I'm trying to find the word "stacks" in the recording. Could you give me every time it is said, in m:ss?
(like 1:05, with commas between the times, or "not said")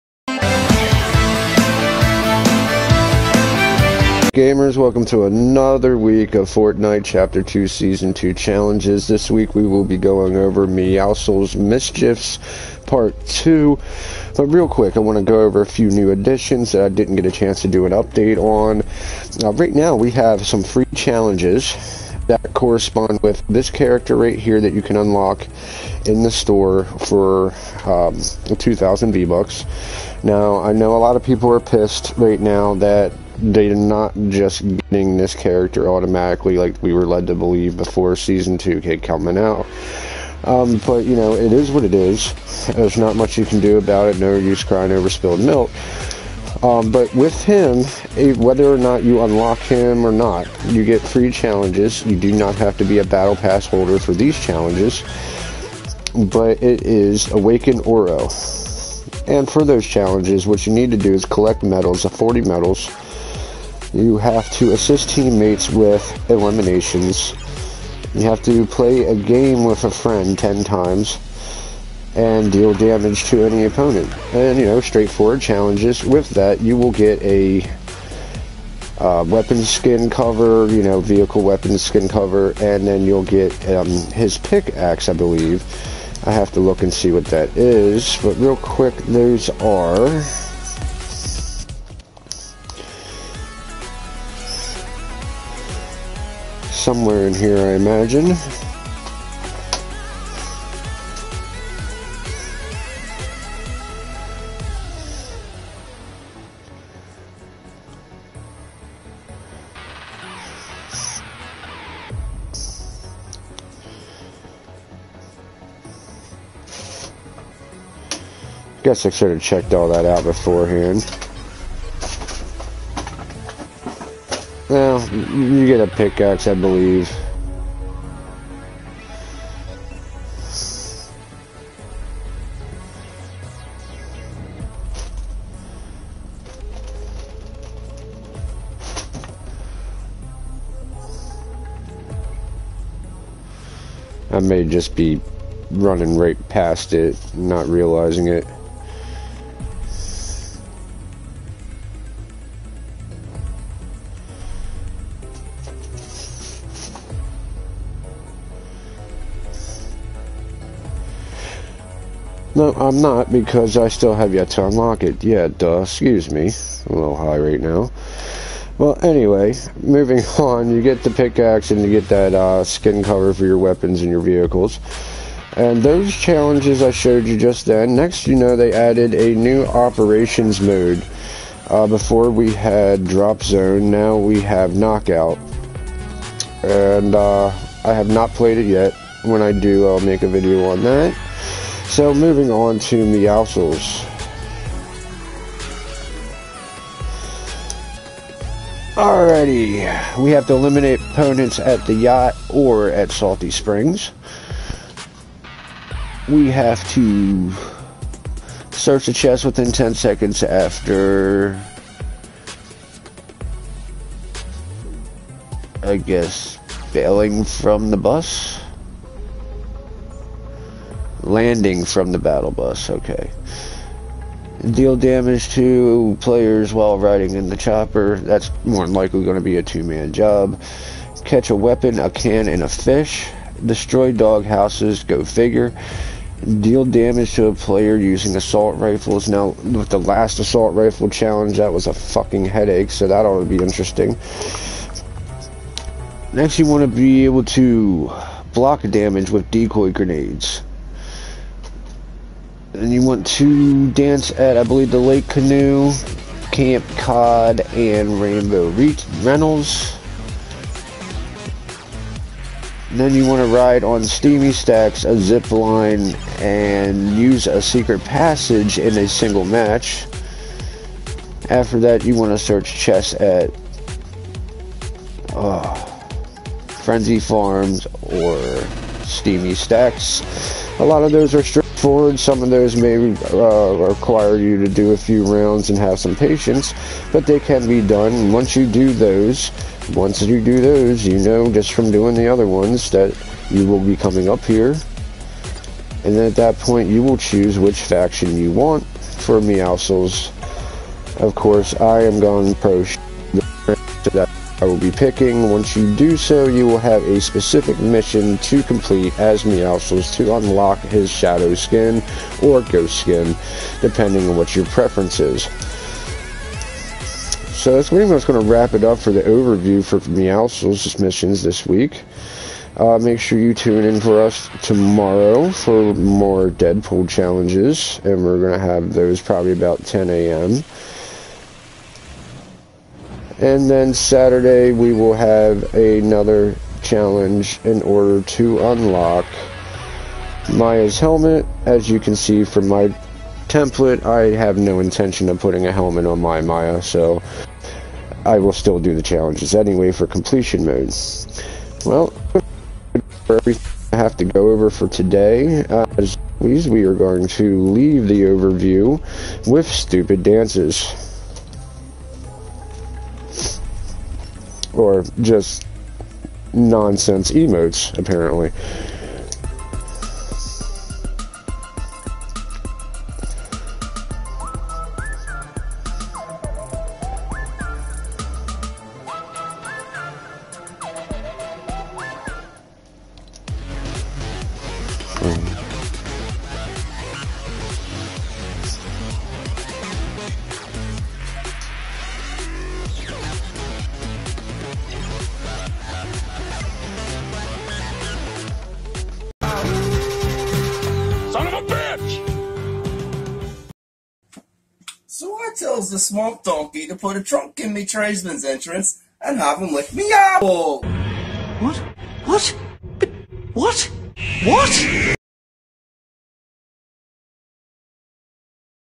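4:24, 4:39.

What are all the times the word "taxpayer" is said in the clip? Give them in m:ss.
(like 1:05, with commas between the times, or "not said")
not said.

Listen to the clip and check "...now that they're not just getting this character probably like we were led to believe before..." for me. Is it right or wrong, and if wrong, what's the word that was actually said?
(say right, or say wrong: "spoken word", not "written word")
wrong: "automatically", not "probably".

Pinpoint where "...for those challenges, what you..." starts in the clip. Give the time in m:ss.
0:59.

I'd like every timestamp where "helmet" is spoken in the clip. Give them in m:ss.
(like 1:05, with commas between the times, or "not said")
5:40, 5:45.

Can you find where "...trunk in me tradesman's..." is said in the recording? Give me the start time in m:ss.
6:47.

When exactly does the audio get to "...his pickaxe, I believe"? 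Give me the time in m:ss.
1:23.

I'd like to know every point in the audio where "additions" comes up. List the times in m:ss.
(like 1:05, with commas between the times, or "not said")
0:16.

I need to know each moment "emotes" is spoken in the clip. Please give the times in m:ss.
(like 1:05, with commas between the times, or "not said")
6:07.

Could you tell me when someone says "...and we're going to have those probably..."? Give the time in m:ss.
5:28.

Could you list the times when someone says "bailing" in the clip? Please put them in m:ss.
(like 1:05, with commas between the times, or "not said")
3:36.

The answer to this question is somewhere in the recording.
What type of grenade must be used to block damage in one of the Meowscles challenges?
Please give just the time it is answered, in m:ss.
4:09.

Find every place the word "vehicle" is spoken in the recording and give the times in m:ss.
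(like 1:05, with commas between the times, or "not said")
1:21, 2:54.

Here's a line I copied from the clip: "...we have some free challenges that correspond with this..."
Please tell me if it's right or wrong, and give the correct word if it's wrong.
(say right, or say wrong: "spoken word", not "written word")
right.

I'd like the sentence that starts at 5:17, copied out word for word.
So that's pretty much going to wrap it up for the overview for Meowscles' missions this week.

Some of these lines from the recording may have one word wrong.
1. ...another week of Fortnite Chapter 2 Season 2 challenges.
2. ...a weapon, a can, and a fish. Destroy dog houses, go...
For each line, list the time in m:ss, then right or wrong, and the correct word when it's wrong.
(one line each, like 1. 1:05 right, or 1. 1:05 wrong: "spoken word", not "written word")
1. 0:05 right
2. 3:51 right.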